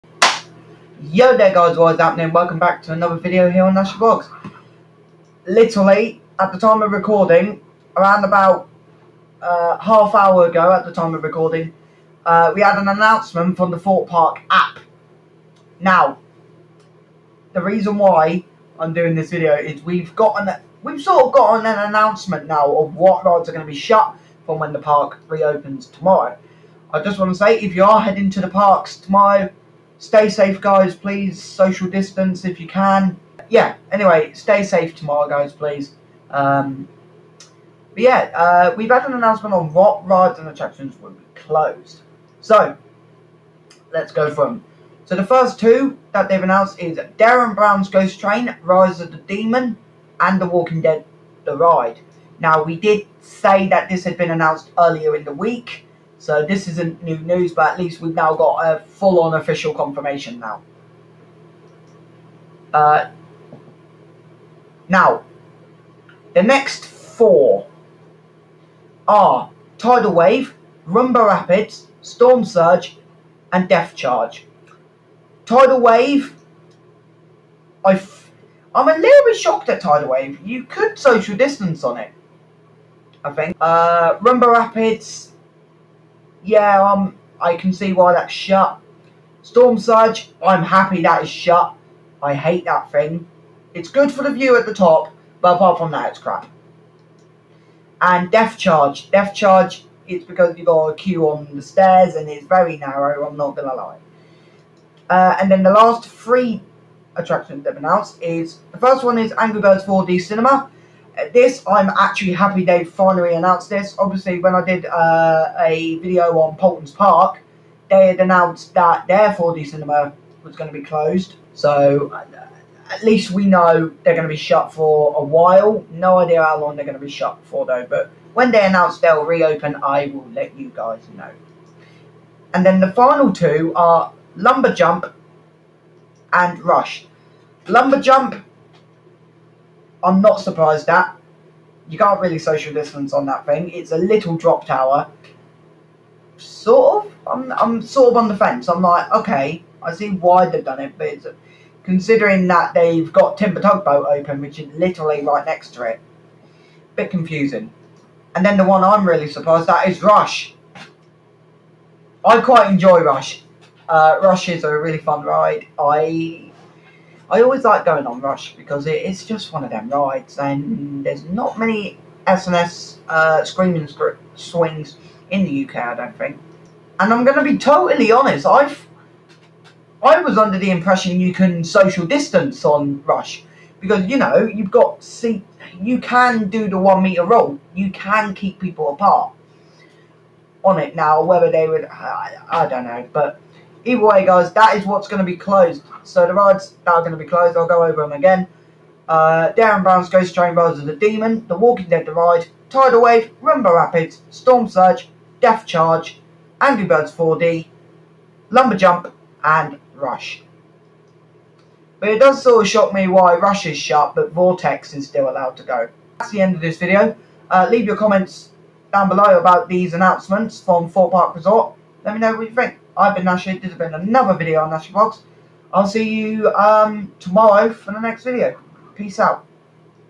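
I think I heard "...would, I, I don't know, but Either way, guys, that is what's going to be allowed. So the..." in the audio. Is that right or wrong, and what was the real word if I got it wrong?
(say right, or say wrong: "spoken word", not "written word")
wrong: "closed", not "allowed".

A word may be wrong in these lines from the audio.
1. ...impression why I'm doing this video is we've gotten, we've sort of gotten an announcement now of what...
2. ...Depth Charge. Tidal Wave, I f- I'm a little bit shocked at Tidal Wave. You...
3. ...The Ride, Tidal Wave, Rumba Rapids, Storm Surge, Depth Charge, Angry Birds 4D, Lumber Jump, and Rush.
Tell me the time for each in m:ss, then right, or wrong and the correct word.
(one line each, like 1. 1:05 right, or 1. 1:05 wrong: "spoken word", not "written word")
1. 0:17 wrong: "reason", not "impression"
2. 1:13 right
3. 3:22 right.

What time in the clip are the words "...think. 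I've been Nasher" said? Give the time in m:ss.
3:42.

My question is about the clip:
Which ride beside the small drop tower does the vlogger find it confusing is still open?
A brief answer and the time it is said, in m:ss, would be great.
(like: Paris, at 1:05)
Timber Tugboat, at 2:33.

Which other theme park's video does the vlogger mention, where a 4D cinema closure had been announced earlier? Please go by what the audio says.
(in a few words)
Paulton's Park.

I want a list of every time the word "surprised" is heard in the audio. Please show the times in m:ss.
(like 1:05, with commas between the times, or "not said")
2:20, 2:39.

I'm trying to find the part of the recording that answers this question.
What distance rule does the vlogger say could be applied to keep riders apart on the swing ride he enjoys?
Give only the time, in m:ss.
3:06.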